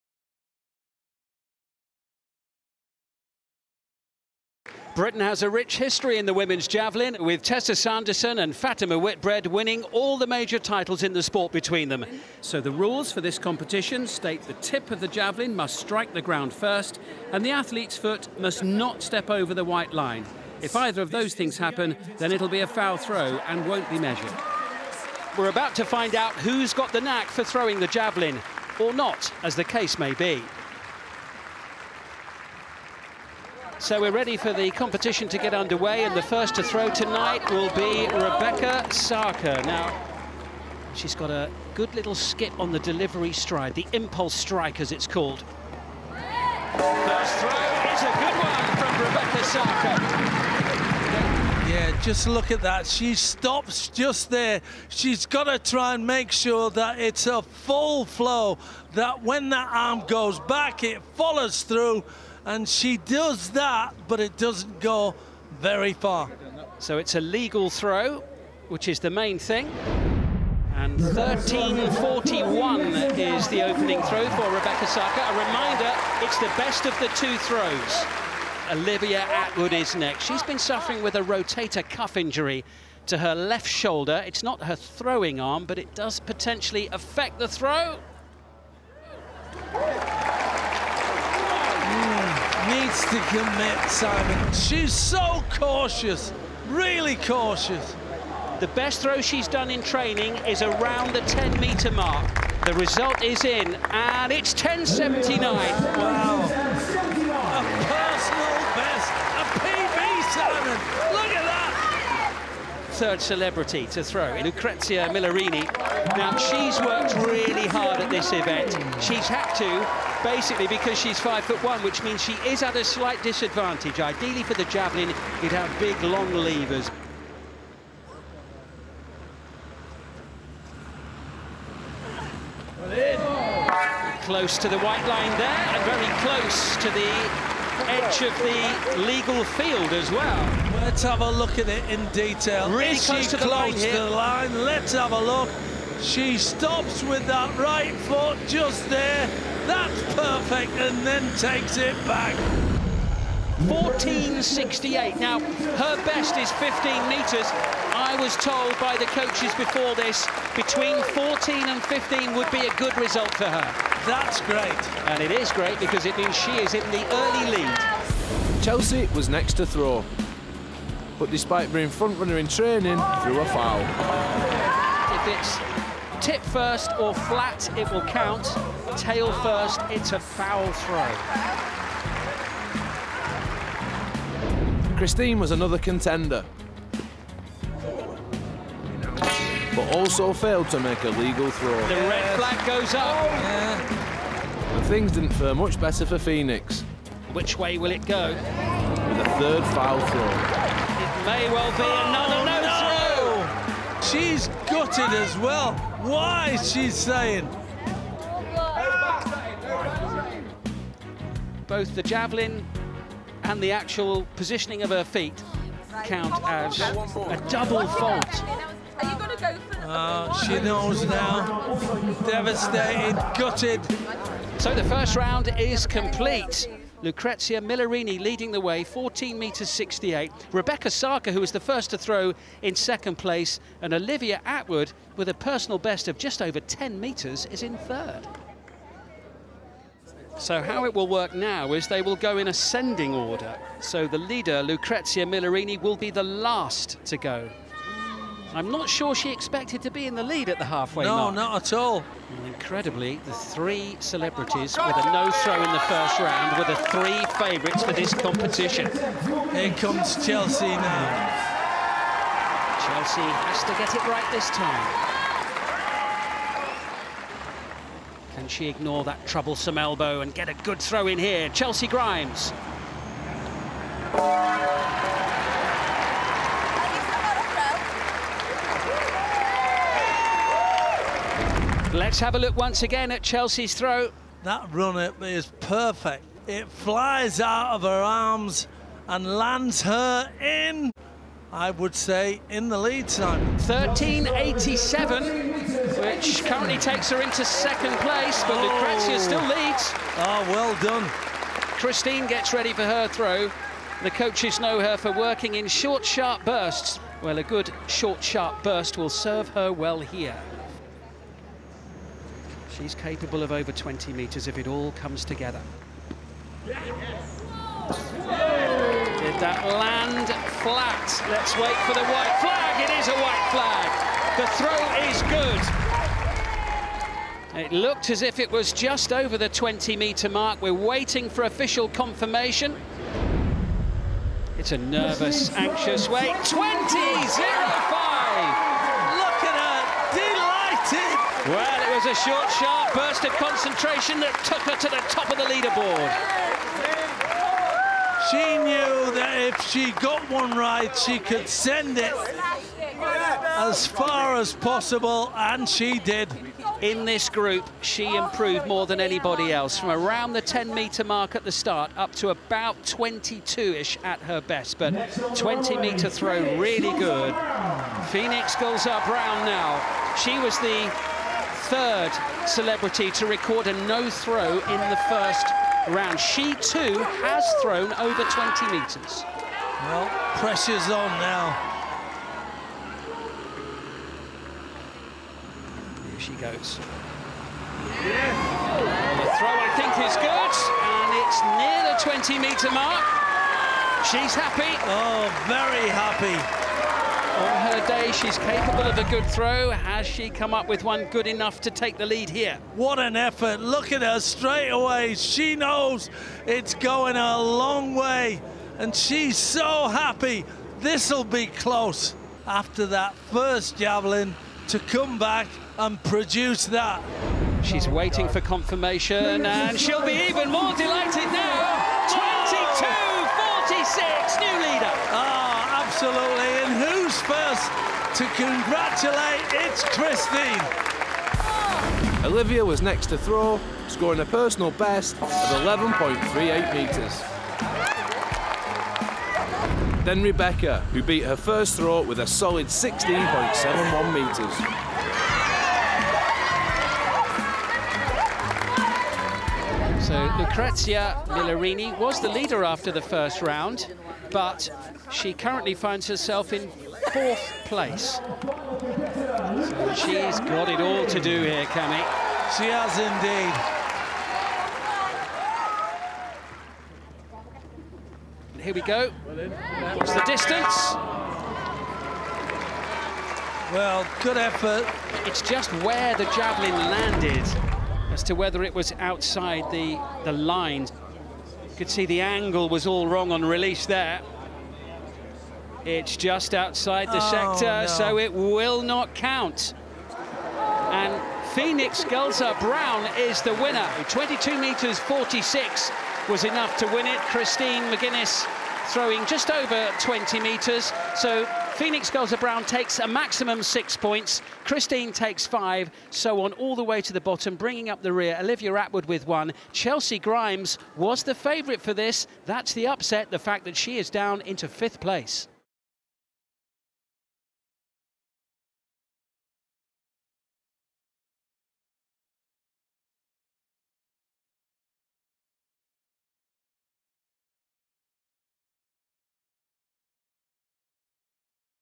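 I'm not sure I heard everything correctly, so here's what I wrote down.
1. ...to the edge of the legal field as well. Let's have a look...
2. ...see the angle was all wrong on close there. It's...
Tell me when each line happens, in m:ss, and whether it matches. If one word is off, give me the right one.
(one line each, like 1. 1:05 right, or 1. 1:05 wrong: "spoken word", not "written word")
1. 2:16 right
2. 8:01 wrong: "release", not "close".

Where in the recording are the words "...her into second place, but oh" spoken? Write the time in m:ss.
4:57.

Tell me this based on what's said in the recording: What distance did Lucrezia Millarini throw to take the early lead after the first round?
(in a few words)
14.68.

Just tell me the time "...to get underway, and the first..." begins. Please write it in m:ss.
0:35.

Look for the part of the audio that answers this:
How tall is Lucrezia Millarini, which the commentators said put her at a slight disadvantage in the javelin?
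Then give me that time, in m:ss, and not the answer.
2:01.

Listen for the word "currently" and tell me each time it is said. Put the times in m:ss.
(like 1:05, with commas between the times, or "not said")
4:56, 7:35.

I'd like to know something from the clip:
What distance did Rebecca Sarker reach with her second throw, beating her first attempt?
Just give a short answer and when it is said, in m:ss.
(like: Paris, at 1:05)
16.71 metres, at 7:22.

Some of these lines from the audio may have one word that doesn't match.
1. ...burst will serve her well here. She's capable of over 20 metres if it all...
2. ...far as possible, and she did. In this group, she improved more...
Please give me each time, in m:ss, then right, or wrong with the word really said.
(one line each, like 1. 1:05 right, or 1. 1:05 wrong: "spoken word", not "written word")
1. 5:08 right
2. 5:53 right.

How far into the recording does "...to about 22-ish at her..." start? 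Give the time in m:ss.
6:02.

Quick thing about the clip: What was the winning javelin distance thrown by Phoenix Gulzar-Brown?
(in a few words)
22.46.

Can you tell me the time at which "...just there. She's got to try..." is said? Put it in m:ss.
0:53.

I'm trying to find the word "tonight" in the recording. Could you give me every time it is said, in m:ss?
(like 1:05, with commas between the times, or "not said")
0:36.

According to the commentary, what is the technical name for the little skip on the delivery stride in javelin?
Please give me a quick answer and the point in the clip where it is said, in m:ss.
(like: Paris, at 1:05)
impulse strike, at 0:43.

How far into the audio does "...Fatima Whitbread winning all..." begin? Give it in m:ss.
0:08.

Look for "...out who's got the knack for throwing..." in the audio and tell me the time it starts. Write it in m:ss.
0:26.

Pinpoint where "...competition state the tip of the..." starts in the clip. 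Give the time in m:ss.
0:13.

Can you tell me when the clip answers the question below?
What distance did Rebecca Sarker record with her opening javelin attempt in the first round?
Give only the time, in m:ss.
1:10.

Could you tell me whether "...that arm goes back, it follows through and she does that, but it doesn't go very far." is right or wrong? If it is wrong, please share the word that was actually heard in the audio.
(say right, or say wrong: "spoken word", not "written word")
right.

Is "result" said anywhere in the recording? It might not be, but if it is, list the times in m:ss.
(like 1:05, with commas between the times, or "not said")
1:42, 2:42.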